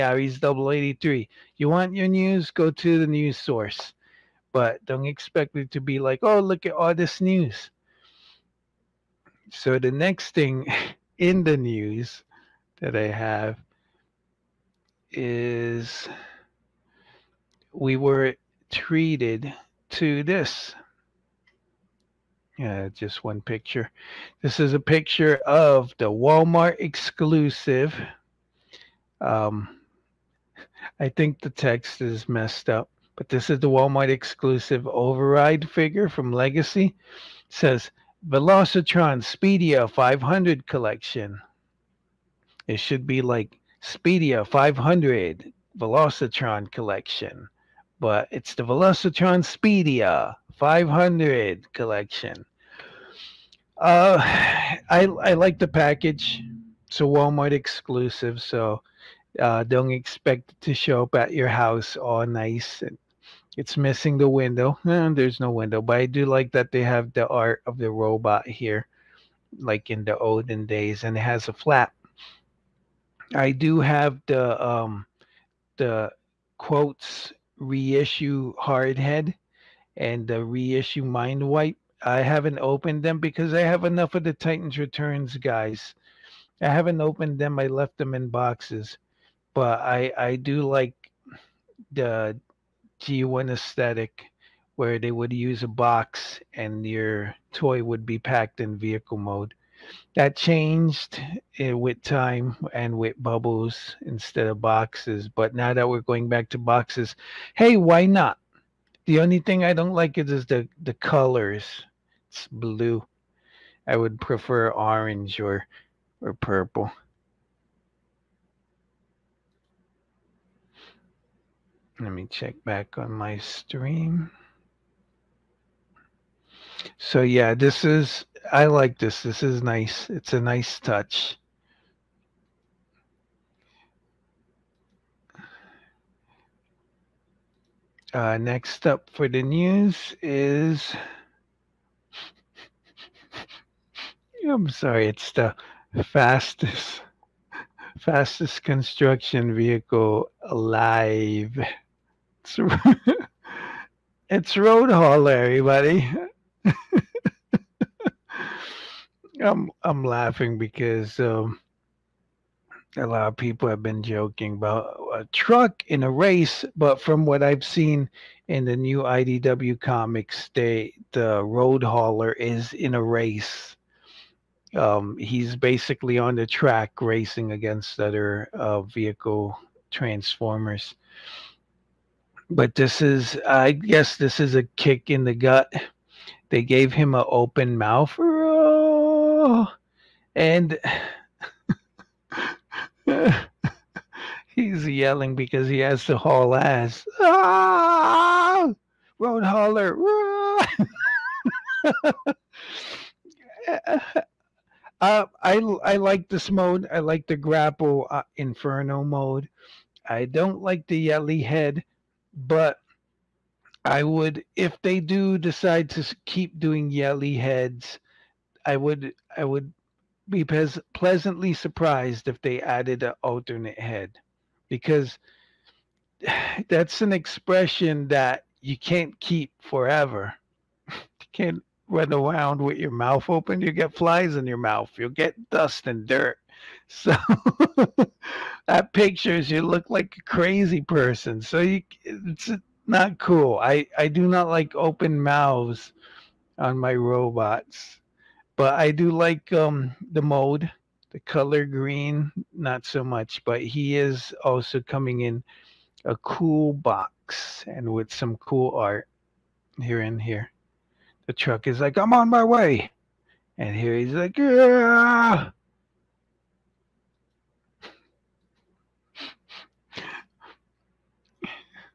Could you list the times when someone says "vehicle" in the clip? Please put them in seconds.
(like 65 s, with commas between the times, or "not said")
98 s, 149 s, 178 s.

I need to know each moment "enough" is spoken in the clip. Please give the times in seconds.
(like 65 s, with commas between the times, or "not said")
83 s.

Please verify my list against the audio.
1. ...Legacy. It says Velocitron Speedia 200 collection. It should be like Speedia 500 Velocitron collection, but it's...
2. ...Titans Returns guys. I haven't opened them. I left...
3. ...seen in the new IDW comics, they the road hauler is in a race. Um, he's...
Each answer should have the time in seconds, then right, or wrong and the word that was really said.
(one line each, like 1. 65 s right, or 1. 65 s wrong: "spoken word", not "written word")
1. 36 s wrong: "500", not "200"
2. 84 s right
3. 167 s right.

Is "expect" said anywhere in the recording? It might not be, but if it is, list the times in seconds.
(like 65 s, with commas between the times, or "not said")
5 s, 59 s.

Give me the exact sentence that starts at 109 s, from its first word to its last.
The only thing I don't like is, is the, the colors.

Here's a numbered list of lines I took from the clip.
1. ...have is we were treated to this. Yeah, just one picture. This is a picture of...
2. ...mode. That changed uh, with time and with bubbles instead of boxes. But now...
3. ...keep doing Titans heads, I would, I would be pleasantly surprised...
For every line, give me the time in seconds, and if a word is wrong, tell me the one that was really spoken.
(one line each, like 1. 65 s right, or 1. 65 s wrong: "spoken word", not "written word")
1. 13 s right
2. 99 s right
3. 216 s wrong: "Yelly", not "Titans".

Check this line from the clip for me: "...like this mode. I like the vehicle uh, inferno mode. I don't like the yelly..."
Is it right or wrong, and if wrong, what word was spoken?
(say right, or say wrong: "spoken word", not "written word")
wrong: "grapple", not "vehicle".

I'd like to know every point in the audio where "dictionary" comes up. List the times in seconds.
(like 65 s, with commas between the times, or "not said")
not said.